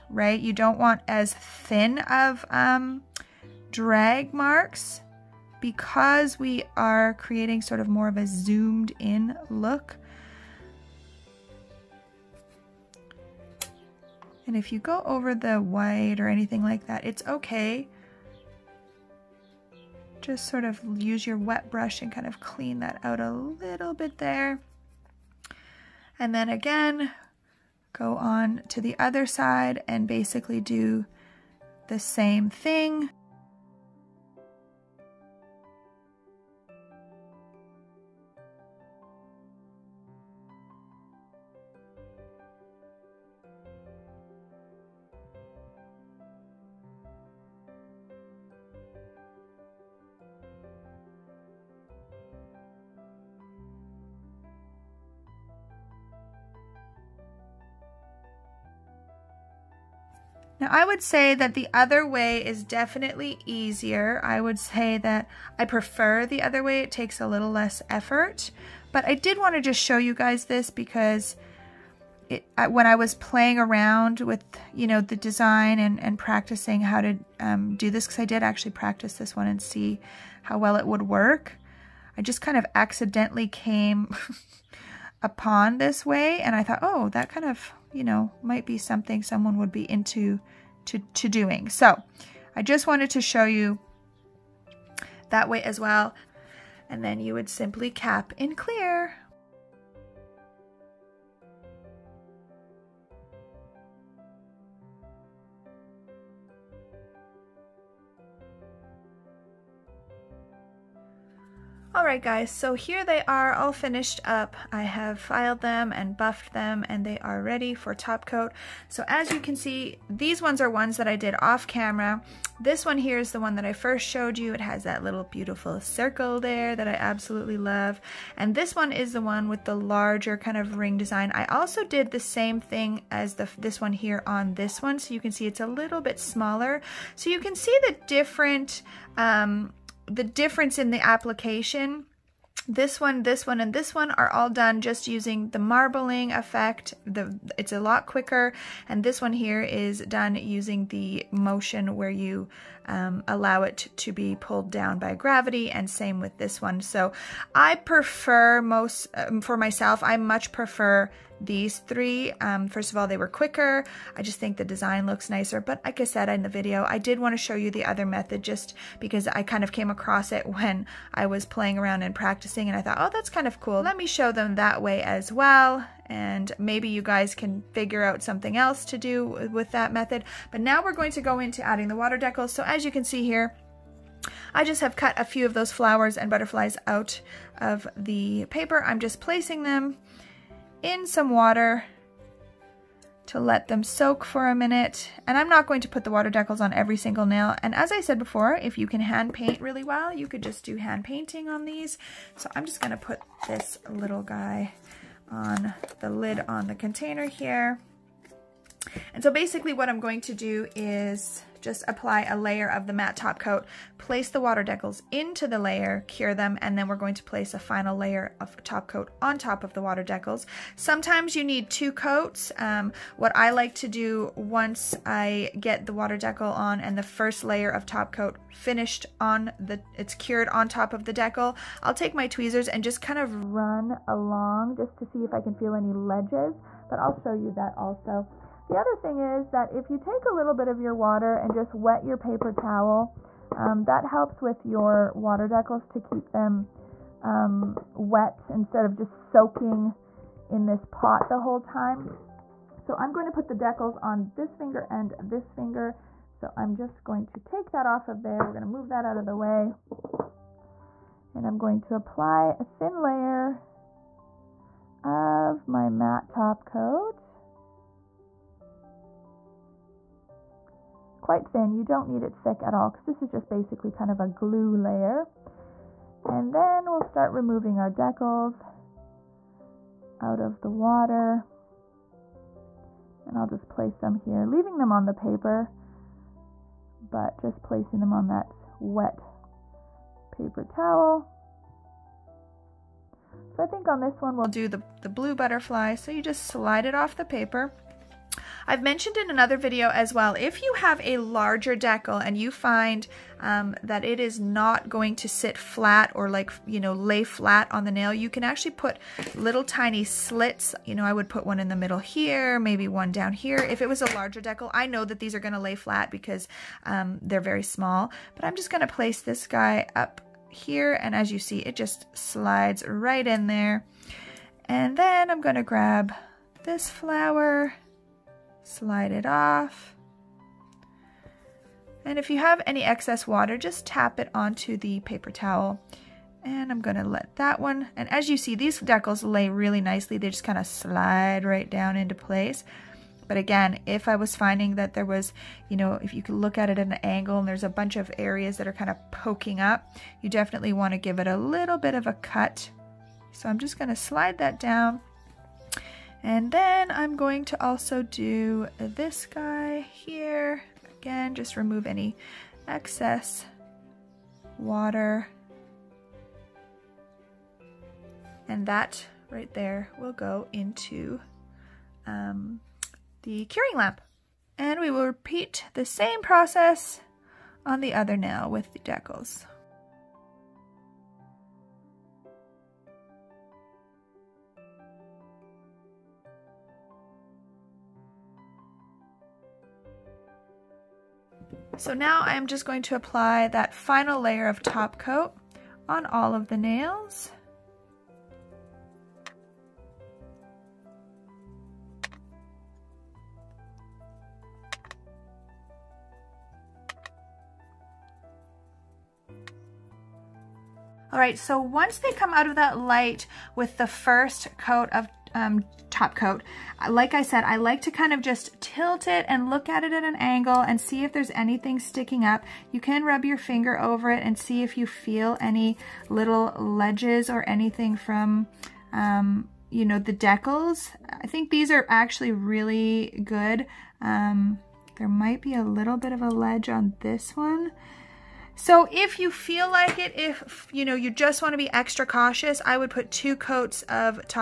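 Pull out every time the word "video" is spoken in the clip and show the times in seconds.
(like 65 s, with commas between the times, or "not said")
166 s, 299 s.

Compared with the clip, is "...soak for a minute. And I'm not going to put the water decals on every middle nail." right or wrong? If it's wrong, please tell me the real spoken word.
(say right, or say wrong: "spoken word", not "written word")
wrong: "single", not "middle".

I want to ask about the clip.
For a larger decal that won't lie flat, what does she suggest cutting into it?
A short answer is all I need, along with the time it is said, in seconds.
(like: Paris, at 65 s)
little tiny slits, at 309 s.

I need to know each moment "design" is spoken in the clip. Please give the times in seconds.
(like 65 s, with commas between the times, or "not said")
75 s, 130 s, 164 s.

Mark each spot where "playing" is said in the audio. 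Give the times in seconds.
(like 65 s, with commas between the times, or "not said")
73 s, 171 s.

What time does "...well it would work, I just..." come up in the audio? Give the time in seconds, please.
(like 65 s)
80 s.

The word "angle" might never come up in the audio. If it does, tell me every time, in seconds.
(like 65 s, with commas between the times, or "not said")
347 s, 420 s.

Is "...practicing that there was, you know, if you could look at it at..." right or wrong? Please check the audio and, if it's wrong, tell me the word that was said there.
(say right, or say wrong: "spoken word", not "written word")
wrong: "finding", not "practicing".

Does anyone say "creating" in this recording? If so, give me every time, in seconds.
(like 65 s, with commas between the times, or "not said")
7 s.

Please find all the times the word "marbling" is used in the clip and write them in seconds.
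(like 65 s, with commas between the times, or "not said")
145 s.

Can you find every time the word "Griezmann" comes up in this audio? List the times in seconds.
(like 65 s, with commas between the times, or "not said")
not said.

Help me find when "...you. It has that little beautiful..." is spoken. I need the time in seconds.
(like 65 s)
124 s.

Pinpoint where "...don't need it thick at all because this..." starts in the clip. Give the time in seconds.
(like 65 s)
271 s.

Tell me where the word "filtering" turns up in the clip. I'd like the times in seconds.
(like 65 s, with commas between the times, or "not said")
not said.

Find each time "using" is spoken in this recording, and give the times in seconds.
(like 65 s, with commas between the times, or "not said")
145 s, 150 s.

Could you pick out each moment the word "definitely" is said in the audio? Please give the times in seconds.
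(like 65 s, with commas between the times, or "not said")
62 s, 350 s.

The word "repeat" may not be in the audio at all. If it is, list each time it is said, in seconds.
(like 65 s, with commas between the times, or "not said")
375 s.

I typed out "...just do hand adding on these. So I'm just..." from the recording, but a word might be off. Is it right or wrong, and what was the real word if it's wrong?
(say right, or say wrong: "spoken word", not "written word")
wrong: "painting", not "adding".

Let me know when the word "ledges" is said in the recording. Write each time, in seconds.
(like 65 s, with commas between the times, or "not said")
235 s, 426 s, 436 s.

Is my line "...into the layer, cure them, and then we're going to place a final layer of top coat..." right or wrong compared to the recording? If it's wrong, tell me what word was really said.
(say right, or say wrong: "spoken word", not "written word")
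right.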